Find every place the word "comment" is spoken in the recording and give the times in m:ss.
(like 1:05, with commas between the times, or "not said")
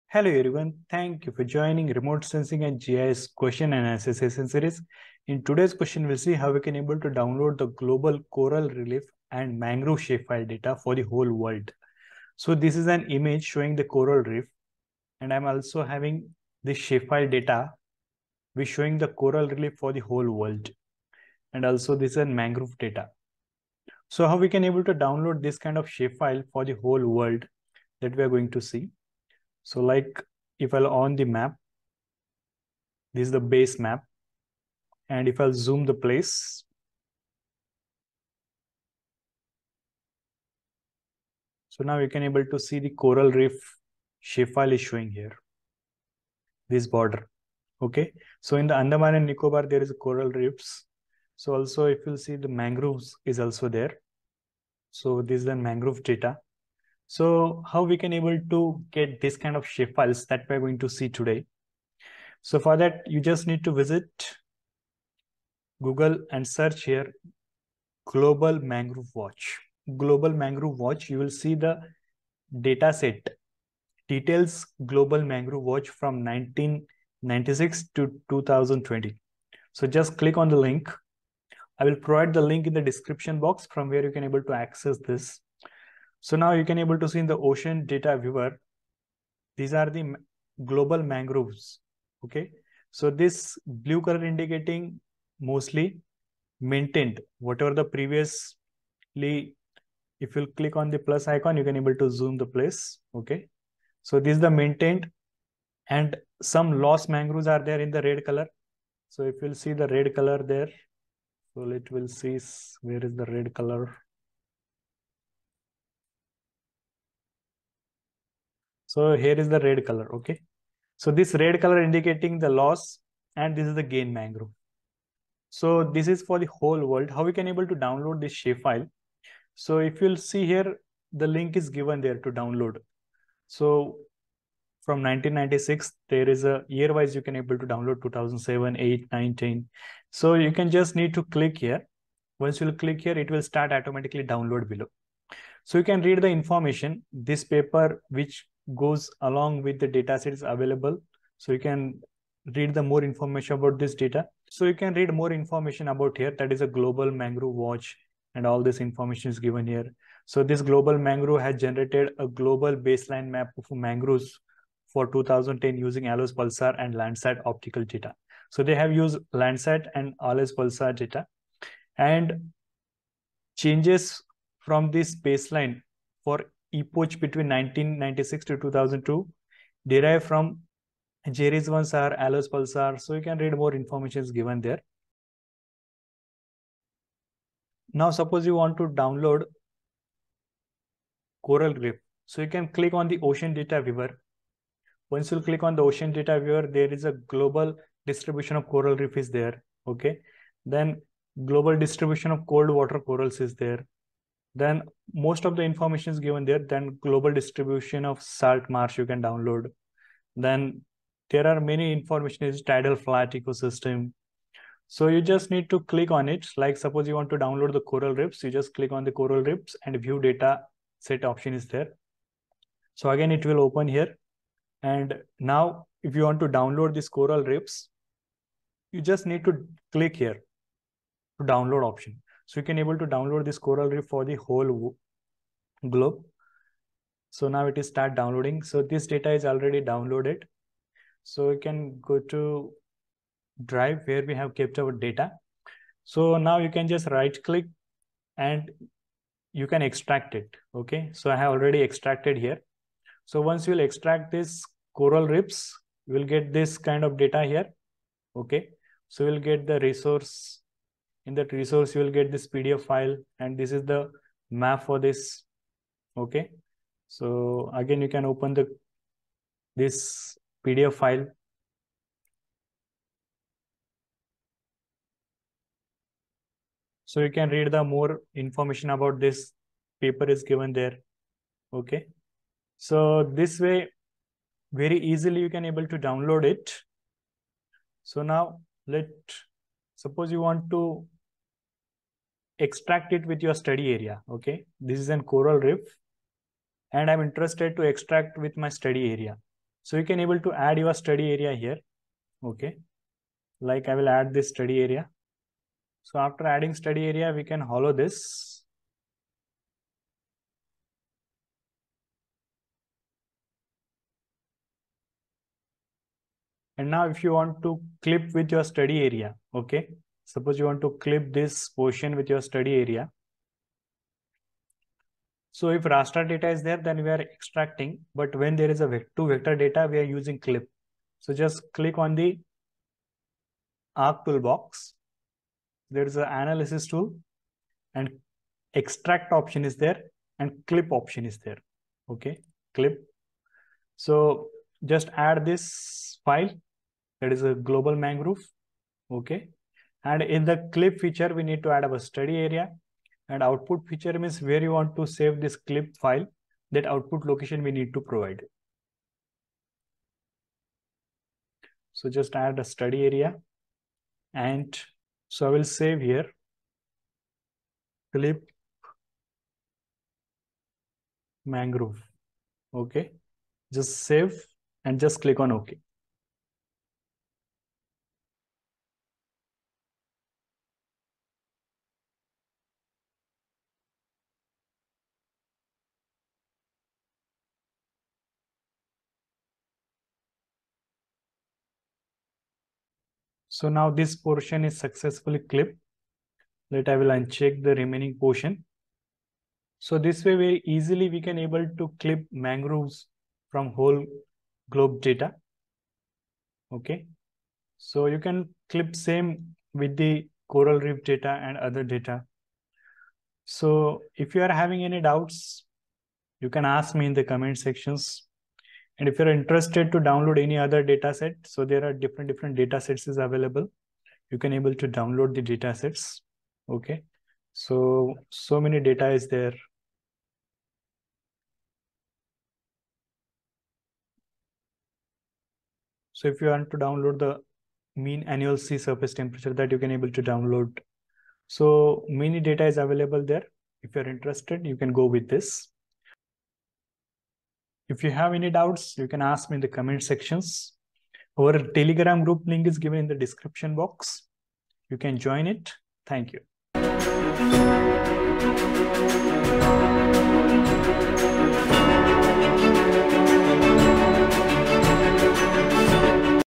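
6:57, 7:29.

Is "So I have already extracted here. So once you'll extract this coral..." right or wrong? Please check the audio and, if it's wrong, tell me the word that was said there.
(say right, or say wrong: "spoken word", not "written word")
right.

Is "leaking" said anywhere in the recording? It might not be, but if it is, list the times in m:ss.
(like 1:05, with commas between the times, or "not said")
not said.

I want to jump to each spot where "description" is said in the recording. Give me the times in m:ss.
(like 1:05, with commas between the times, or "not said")
1:22, 7:33.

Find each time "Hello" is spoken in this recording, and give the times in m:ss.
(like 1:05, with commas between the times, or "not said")
0:00.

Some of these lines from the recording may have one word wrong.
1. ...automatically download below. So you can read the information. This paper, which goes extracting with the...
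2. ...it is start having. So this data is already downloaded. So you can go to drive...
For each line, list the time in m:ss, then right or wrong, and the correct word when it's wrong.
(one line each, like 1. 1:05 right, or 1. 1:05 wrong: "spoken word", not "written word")
1. 2:23 wrong: "along", not "extracting"
2. 3:57 wrong: "downloading", not "having".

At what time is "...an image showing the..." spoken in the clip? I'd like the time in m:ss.
0:12.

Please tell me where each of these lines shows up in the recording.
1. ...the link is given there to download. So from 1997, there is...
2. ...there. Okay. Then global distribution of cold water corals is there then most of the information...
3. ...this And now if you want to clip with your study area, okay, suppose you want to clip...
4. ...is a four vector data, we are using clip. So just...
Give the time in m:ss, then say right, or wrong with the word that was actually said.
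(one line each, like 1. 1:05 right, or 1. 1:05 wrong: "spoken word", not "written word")
1. 2:11 wrong: "1996", not "1997"
2. 3:19 right
3. 5:07 right
4. 5:28 wrong: "two", not "four".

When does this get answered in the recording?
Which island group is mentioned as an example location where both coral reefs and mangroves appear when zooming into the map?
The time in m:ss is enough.
0:48.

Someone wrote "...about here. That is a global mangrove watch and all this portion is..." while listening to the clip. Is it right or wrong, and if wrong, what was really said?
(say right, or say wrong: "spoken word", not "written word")
wrong: "information", not "portion".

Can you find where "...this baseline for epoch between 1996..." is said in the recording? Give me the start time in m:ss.
2:54.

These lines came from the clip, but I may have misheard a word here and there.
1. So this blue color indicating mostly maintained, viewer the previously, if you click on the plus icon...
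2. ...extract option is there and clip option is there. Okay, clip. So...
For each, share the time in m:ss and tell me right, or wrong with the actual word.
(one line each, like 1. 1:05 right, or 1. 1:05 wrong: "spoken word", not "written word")
1. 1:32 wrong: "whatever", not "viewer"
2. 5:38 right.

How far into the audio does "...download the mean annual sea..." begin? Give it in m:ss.
7:16.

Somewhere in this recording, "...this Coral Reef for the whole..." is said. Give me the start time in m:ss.
3:53.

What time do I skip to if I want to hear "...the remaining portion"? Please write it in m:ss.
6:37.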